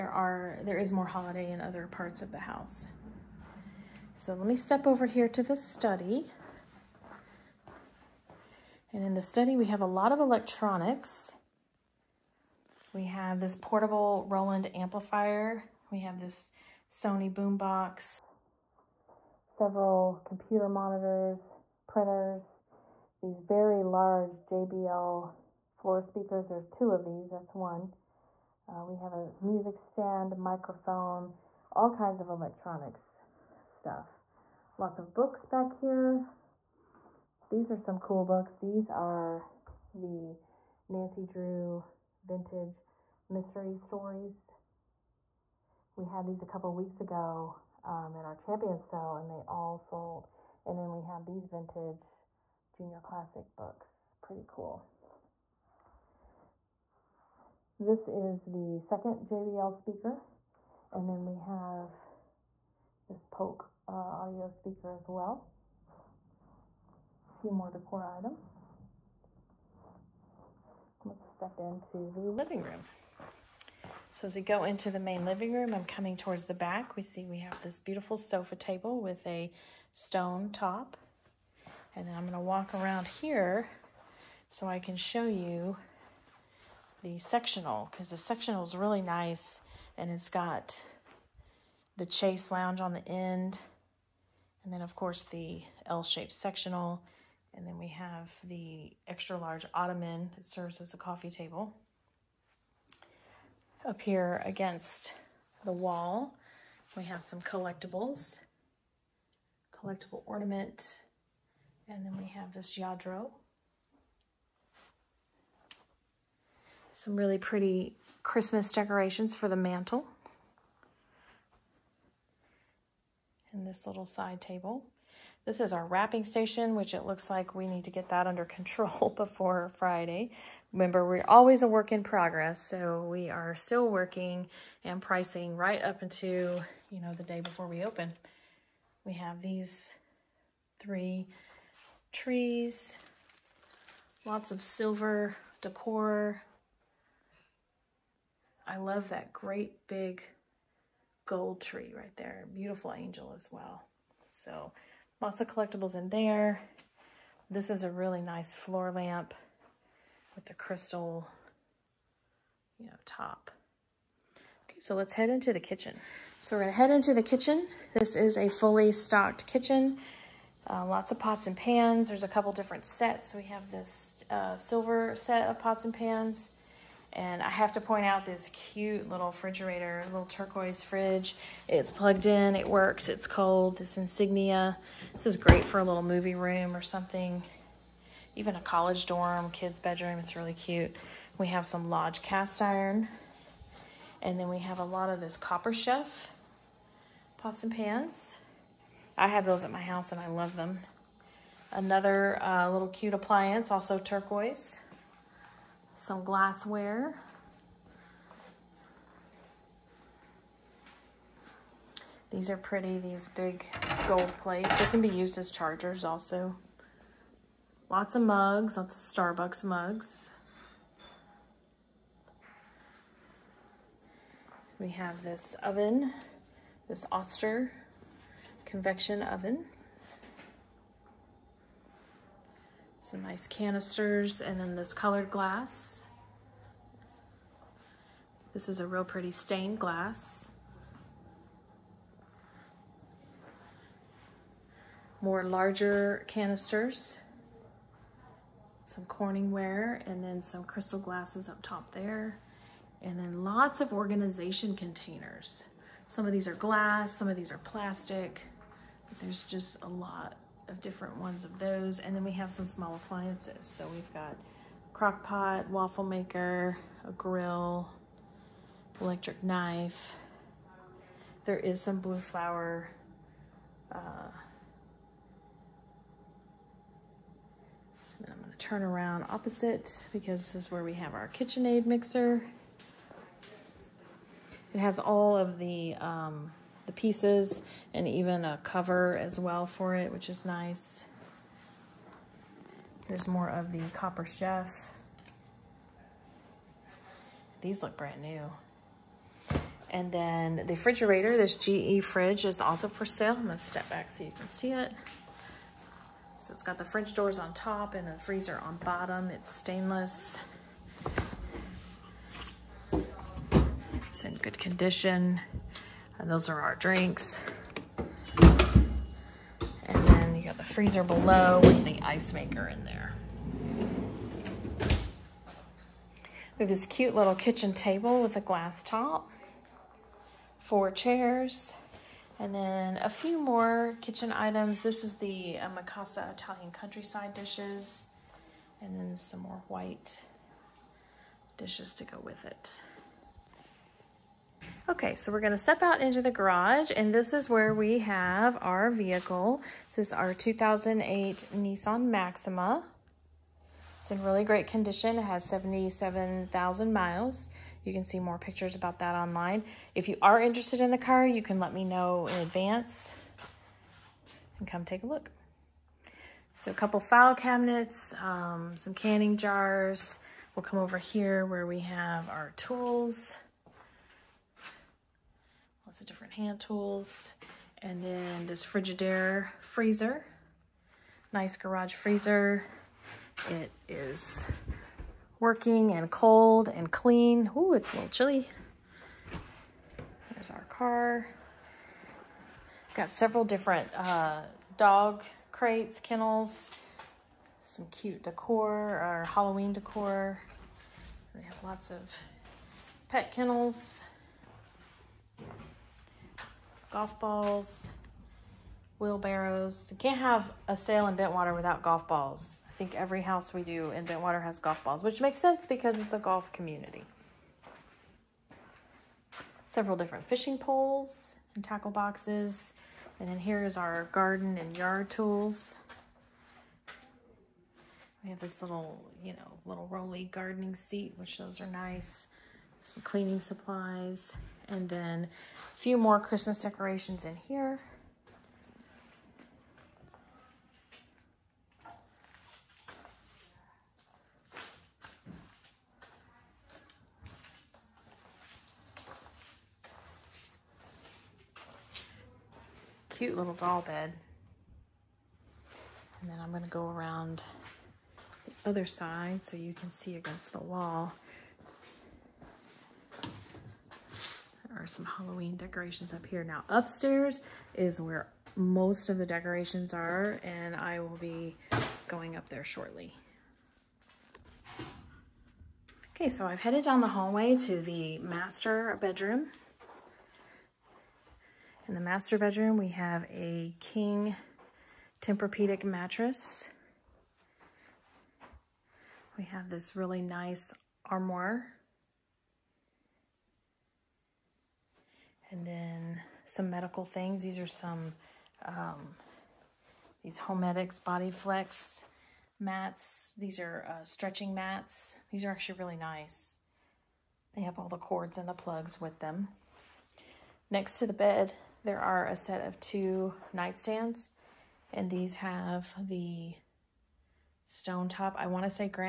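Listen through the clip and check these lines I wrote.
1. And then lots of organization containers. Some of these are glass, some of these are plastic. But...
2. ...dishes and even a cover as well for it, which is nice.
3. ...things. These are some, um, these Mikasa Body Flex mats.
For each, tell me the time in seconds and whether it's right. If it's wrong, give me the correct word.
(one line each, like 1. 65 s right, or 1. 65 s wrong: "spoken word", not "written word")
1. 253 s right
2. 286 s wrong: "pieces", not "dishes"
3. 497 s wrong: "Homedics", not "Mikasa".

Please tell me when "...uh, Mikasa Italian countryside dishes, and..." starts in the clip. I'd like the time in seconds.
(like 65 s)
335 s.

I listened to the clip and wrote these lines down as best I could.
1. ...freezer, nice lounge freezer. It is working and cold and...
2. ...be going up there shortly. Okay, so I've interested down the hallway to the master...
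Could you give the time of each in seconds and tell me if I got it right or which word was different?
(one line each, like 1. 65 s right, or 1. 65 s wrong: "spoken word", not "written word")
1. 379 s wrong: "garage", not "lounge"
2. 471 s wrong: "headed", not "interested".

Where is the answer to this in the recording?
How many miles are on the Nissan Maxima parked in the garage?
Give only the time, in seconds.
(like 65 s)
355 s.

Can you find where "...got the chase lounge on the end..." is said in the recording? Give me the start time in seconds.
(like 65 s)
90 s.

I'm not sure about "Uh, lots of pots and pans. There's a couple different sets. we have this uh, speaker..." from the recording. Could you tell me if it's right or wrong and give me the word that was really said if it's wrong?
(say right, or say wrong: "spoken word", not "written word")
wrong: "silver", not "speaker".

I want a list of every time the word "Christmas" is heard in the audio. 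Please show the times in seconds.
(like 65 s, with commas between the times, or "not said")
118 s, 436 s.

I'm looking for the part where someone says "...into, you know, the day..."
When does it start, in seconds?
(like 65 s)
136 s.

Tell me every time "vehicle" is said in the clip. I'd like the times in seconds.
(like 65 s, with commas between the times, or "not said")
348 s.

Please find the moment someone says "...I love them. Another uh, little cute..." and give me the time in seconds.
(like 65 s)
200 s.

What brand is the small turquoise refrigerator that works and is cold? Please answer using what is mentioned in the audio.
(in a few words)
Insignia.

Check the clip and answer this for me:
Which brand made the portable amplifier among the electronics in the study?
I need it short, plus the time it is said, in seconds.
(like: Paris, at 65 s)
Roland, at 14 s.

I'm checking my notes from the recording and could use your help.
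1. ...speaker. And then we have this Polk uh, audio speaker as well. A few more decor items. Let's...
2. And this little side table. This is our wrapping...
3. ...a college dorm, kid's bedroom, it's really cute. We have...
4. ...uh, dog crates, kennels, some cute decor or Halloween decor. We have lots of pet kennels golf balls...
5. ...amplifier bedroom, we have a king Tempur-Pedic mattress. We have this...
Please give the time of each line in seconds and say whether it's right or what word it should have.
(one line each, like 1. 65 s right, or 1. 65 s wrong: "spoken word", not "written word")
1. 59 s right
2. 123 s right
3. 188 s right
4. 393 s right
5. 481 s wrong: "master", not "amplifier".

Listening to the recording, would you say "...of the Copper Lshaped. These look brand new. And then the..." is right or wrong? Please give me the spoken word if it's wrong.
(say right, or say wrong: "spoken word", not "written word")
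wrong: "Chef", not "Lshaped".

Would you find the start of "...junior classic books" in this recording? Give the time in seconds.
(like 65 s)
52 s.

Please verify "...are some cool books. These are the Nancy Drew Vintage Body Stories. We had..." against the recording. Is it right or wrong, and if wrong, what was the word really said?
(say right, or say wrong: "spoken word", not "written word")
wrong: "Mystery", not "Body".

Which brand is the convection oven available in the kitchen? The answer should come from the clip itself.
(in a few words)
Oster.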